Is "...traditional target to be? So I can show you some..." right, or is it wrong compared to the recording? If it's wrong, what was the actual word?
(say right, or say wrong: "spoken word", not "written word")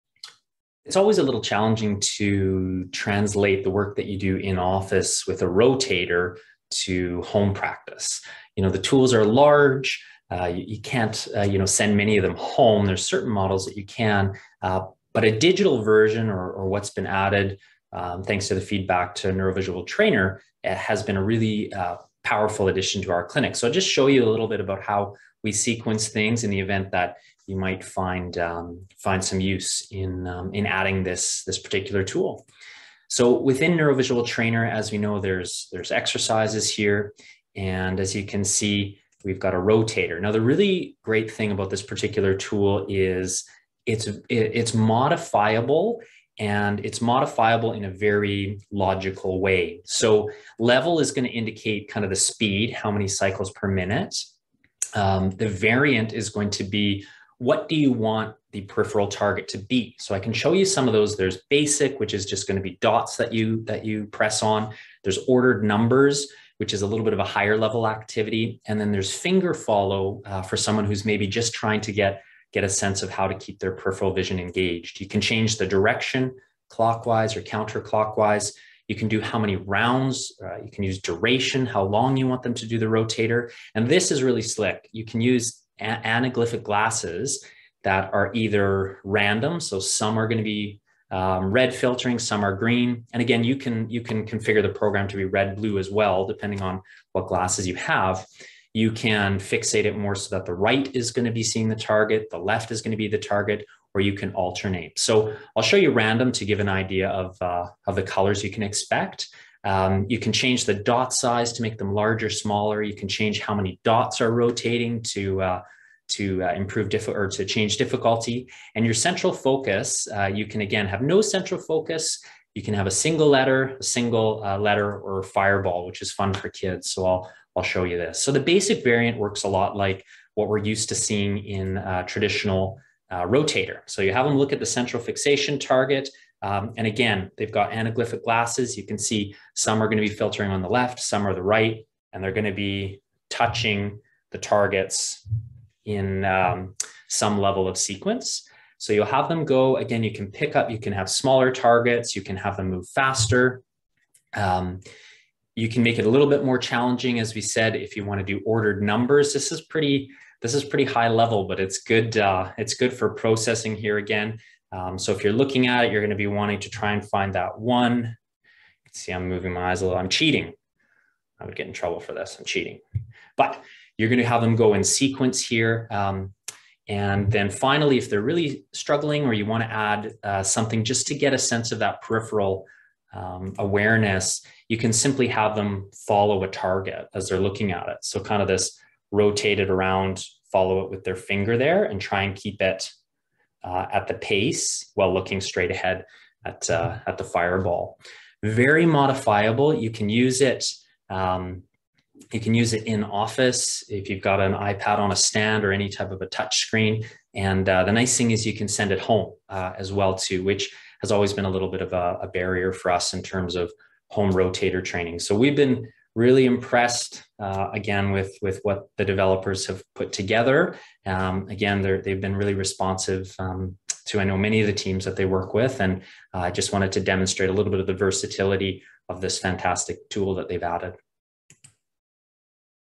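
wrong: "peripheral", not "traditional".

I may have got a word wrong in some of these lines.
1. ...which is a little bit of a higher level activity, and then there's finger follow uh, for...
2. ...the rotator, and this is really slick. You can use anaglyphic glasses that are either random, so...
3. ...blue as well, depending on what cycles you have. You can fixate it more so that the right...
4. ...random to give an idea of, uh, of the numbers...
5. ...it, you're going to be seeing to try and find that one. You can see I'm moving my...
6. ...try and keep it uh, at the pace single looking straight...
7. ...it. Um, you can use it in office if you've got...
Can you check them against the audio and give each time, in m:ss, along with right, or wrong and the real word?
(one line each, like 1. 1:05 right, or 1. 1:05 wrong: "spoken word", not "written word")
1. 1:06 right
2. 1:22 right
3. 1:35 wrong: "glasses", not "cycles"
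4. 1:45 wrong: "colors", not "numbers"
5. 2:45 wrong: "wanting", not "seeing"
6. 3:11 wrong: "while", not "single"
7. 3:20 right.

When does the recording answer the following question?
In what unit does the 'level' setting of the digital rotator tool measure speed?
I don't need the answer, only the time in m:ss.
0:53.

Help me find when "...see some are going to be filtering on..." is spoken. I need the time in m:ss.
2:18.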